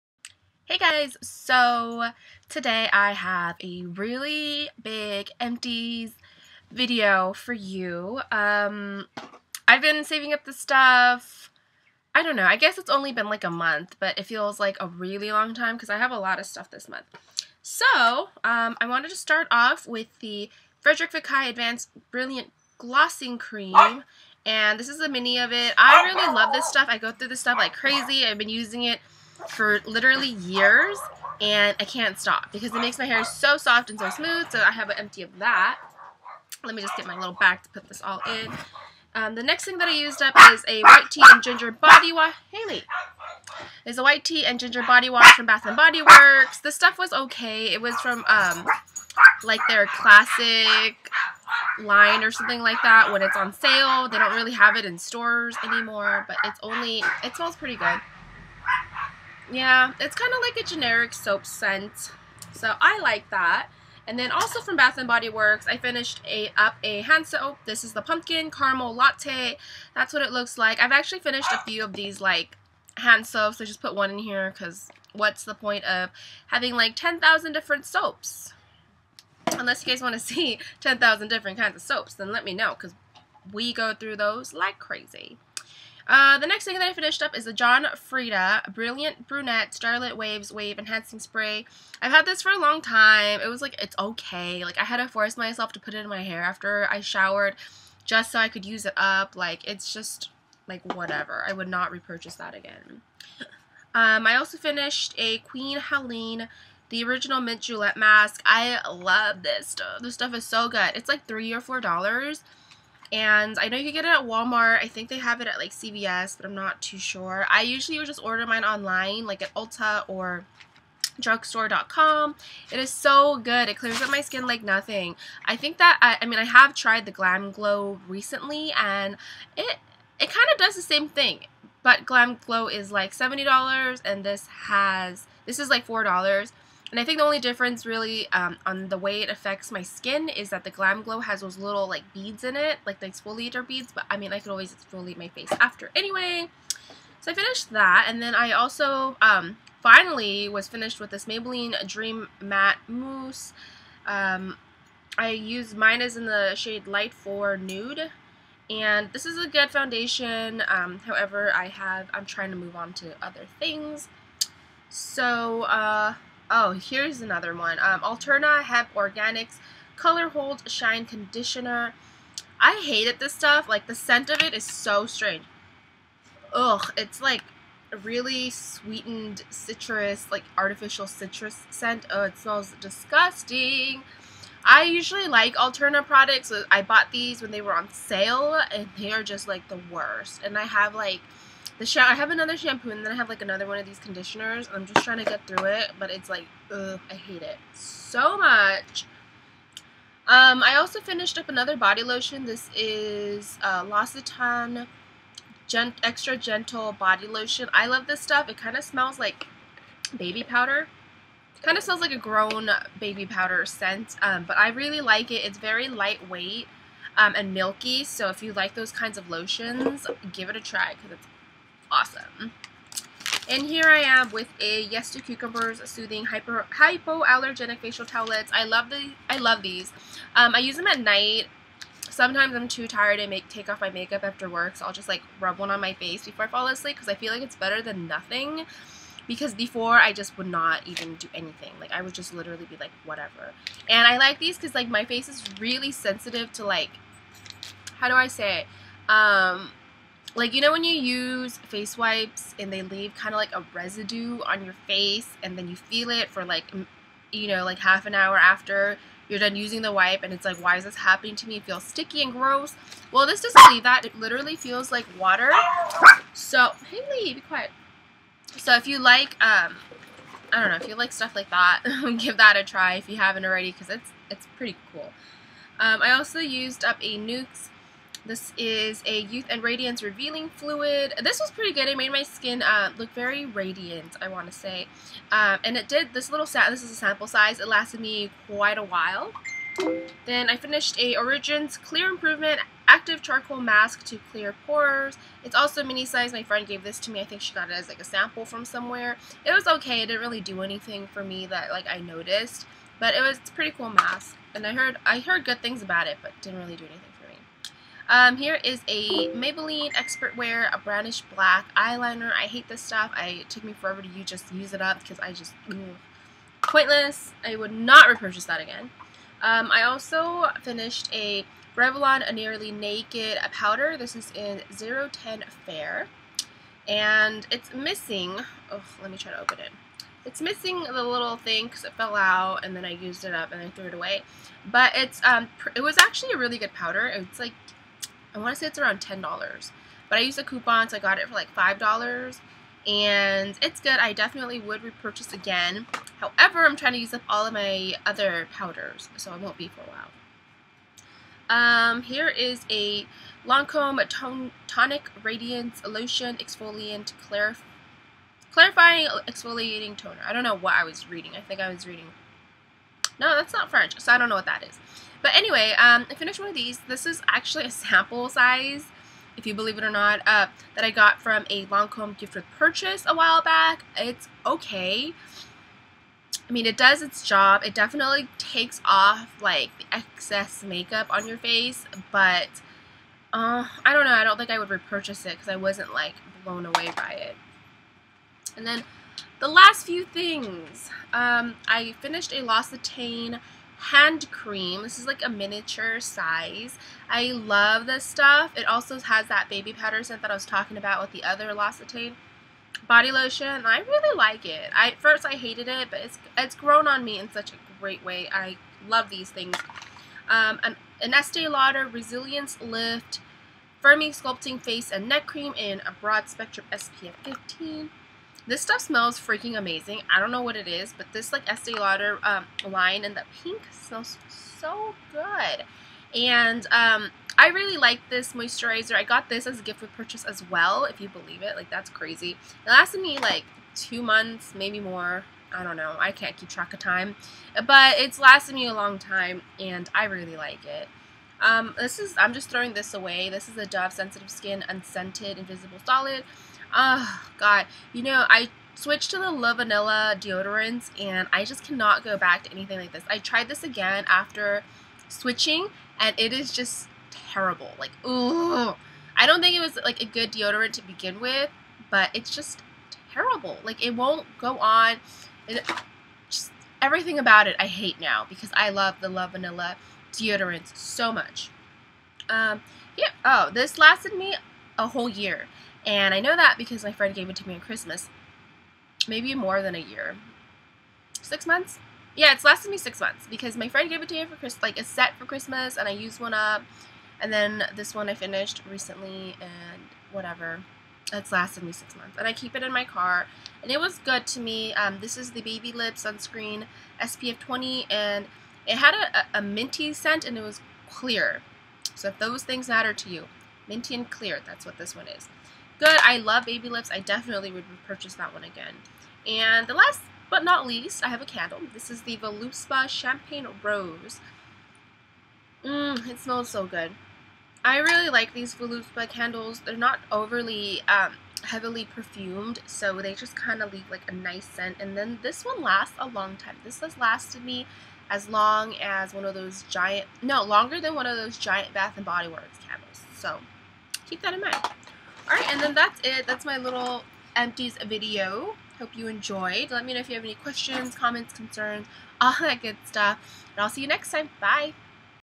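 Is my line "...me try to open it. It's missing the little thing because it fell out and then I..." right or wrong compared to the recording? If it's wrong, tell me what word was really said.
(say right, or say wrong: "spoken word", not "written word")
right.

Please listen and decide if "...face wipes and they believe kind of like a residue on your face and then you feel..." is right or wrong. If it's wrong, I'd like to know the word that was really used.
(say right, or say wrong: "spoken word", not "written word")
wrong: "leave", not "believe".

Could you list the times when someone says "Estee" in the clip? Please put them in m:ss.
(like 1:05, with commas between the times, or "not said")
6:51, 7:01.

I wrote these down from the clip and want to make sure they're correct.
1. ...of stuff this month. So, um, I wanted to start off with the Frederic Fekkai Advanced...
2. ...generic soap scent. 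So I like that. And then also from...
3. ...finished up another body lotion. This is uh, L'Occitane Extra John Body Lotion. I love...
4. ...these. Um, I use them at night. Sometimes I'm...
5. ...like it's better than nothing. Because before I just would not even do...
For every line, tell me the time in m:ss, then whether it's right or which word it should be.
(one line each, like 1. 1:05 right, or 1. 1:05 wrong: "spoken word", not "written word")
1. 0:16 right
2. 1:00 right
3. 3:21 wrong: "Gentle", not "John"
4. 3:49 right
5. 3:57 right.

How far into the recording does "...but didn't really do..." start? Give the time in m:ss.
5:06.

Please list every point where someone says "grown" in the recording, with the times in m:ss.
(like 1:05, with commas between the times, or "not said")
3:32, 6:46.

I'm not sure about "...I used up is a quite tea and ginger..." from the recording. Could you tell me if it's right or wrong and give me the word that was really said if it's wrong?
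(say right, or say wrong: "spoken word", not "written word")
wrong: "white", not "quite".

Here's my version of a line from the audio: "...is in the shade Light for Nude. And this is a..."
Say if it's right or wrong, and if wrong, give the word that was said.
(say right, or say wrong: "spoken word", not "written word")
right.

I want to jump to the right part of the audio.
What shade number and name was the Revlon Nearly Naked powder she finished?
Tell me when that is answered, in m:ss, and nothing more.
5:24.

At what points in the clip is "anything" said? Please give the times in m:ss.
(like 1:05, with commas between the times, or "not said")
4:01, 5:00, 5:06, 7:32.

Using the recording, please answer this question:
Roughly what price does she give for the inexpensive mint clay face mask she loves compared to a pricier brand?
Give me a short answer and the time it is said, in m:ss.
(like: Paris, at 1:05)
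$3 or $4, at 1:51.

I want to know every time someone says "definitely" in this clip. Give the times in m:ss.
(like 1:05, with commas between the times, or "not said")
5:44, 6:17, 8:26.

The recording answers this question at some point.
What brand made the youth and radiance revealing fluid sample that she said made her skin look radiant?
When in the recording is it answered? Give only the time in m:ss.
4:37.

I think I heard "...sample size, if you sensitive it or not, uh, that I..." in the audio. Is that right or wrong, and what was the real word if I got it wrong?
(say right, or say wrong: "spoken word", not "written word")
wrong: "believe", not "sensitive".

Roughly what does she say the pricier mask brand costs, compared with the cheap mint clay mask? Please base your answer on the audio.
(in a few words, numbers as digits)
$70.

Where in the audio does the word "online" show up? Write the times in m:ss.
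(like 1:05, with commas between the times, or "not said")
1:58.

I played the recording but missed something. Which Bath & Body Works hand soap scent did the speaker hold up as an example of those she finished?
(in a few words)
Pumpkin Caramel Latte.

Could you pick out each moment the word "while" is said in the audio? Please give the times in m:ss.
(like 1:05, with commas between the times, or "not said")
4:48, 5:49, 6:13.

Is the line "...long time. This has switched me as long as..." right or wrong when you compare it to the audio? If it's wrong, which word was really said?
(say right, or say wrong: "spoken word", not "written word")
wrong: "lasted", not "switched".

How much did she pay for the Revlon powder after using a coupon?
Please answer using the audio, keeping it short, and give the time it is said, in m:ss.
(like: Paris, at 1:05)
$5, at 5:41.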